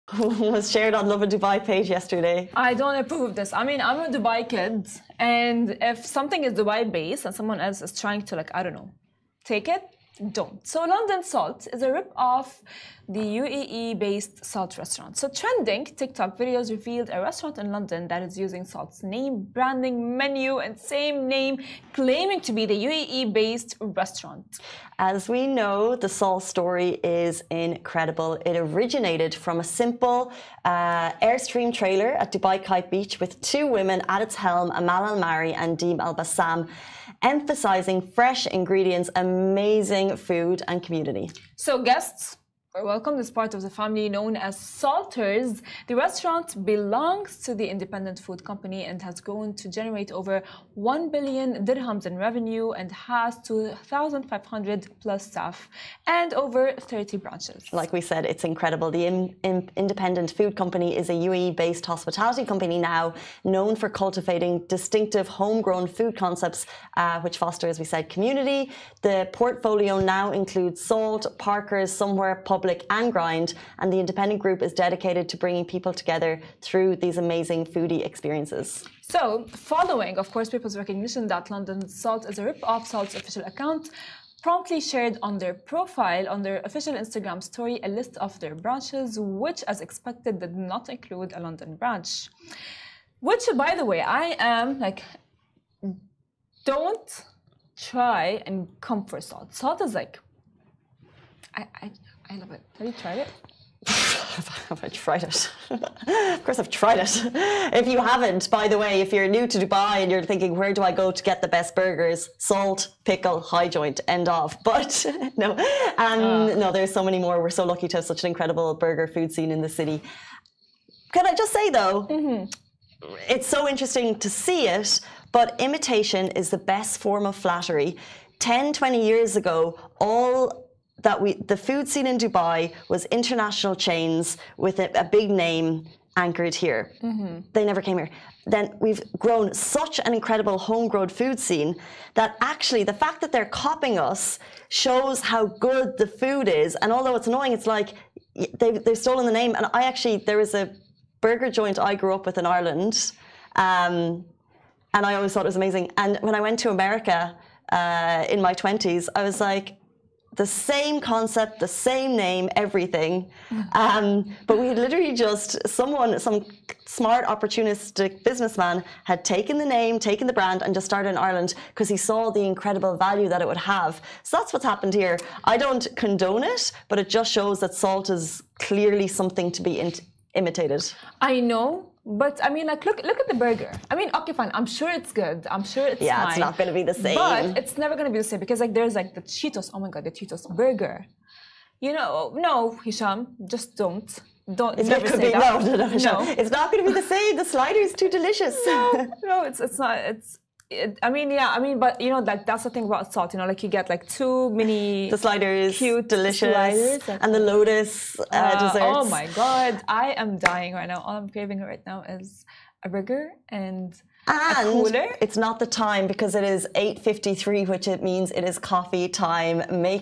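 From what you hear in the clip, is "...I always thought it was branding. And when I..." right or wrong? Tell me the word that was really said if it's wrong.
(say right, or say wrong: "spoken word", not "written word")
wrong: "amazing", not "branding".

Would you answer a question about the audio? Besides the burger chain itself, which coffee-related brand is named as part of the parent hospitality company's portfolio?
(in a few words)
Grind.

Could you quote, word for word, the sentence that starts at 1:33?
Which, by the way, I am like, don't try and come for salt.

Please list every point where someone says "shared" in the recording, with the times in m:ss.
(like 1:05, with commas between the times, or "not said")
0:00, 1:24.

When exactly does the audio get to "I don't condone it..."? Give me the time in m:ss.
2:55.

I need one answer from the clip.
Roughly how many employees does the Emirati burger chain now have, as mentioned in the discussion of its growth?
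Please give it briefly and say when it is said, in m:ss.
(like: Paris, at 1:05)
2,500, at 0:53.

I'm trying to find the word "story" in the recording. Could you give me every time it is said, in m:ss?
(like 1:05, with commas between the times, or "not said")
0:26, 1:27.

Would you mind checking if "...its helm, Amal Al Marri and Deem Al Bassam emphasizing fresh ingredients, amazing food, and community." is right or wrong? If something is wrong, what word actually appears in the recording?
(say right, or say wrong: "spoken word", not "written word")
right.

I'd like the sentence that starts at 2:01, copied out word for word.
Can I just say though, mm -hmm.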